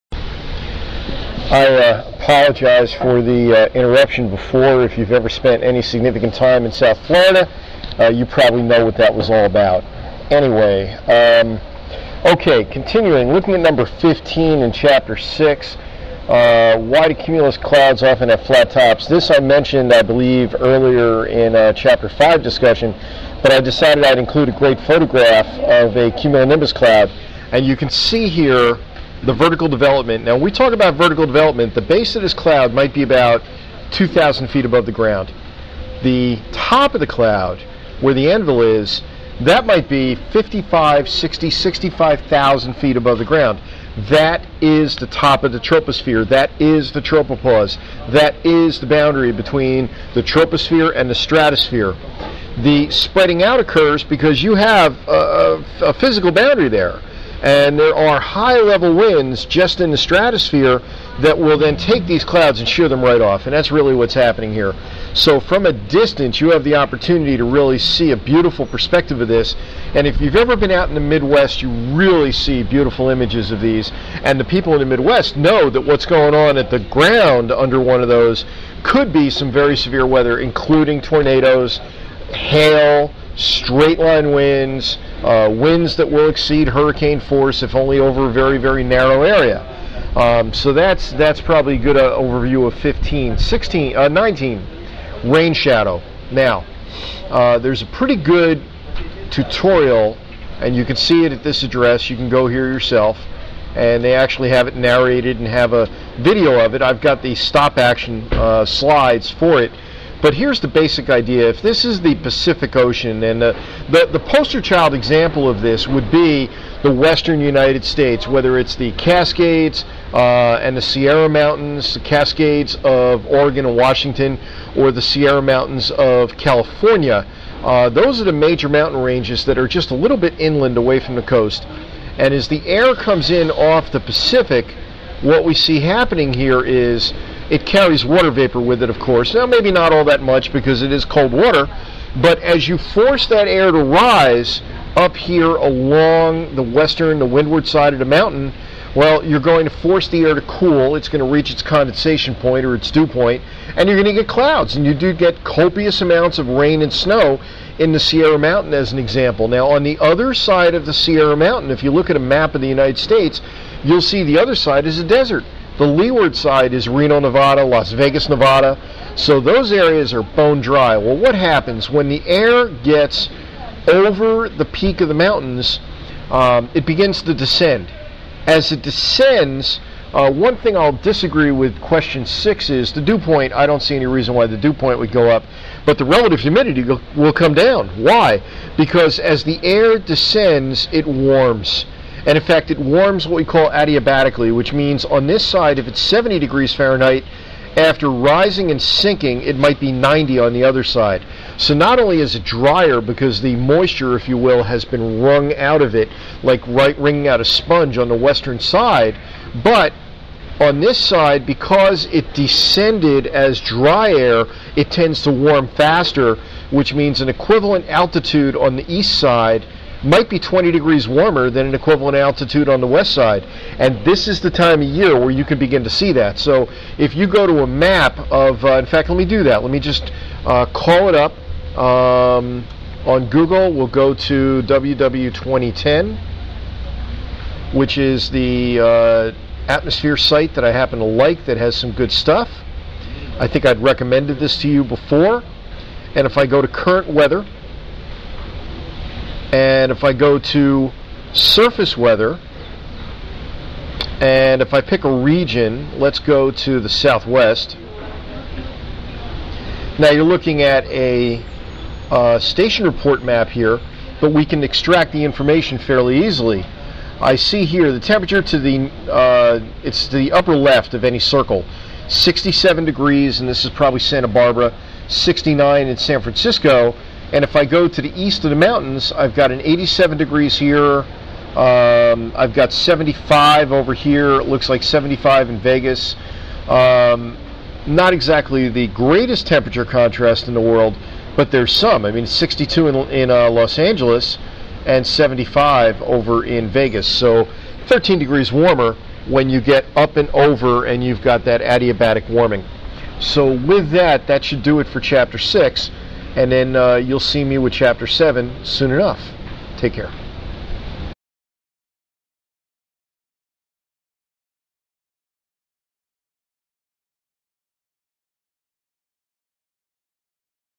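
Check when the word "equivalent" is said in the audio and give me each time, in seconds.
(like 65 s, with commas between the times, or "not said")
217 s, 221 s.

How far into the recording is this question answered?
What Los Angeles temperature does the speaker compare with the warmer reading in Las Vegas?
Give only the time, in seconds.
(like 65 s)
292 s.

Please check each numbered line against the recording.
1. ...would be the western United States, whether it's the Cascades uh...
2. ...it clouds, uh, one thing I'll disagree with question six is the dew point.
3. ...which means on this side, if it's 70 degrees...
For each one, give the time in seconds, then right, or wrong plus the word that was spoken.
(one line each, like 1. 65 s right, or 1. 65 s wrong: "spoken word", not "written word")
1. 115 s right
2. 178 s wrong: "descends", not "clouds"
3. 194 s right.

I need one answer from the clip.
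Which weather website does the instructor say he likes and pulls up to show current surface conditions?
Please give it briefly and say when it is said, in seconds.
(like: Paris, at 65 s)
WW 2010, at 234 s.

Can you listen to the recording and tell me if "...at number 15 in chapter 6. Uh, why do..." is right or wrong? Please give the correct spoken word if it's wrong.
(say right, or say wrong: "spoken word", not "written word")
right.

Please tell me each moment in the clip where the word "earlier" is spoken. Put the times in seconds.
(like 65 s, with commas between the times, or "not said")
20 s.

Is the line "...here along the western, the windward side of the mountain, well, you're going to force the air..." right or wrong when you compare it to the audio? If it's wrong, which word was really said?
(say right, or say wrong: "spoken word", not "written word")
right.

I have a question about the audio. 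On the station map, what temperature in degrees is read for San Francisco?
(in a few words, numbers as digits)
69.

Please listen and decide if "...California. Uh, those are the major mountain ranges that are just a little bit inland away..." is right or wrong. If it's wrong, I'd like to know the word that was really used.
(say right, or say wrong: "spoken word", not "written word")
right.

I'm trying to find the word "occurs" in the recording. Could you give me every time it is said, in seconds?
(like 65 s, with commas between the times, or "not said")
53 s.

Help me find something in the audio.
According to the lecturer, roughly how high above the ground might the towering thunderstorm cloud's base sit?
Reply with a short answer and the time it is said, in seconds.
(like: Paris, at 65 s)
2,000 feet, at 33 s.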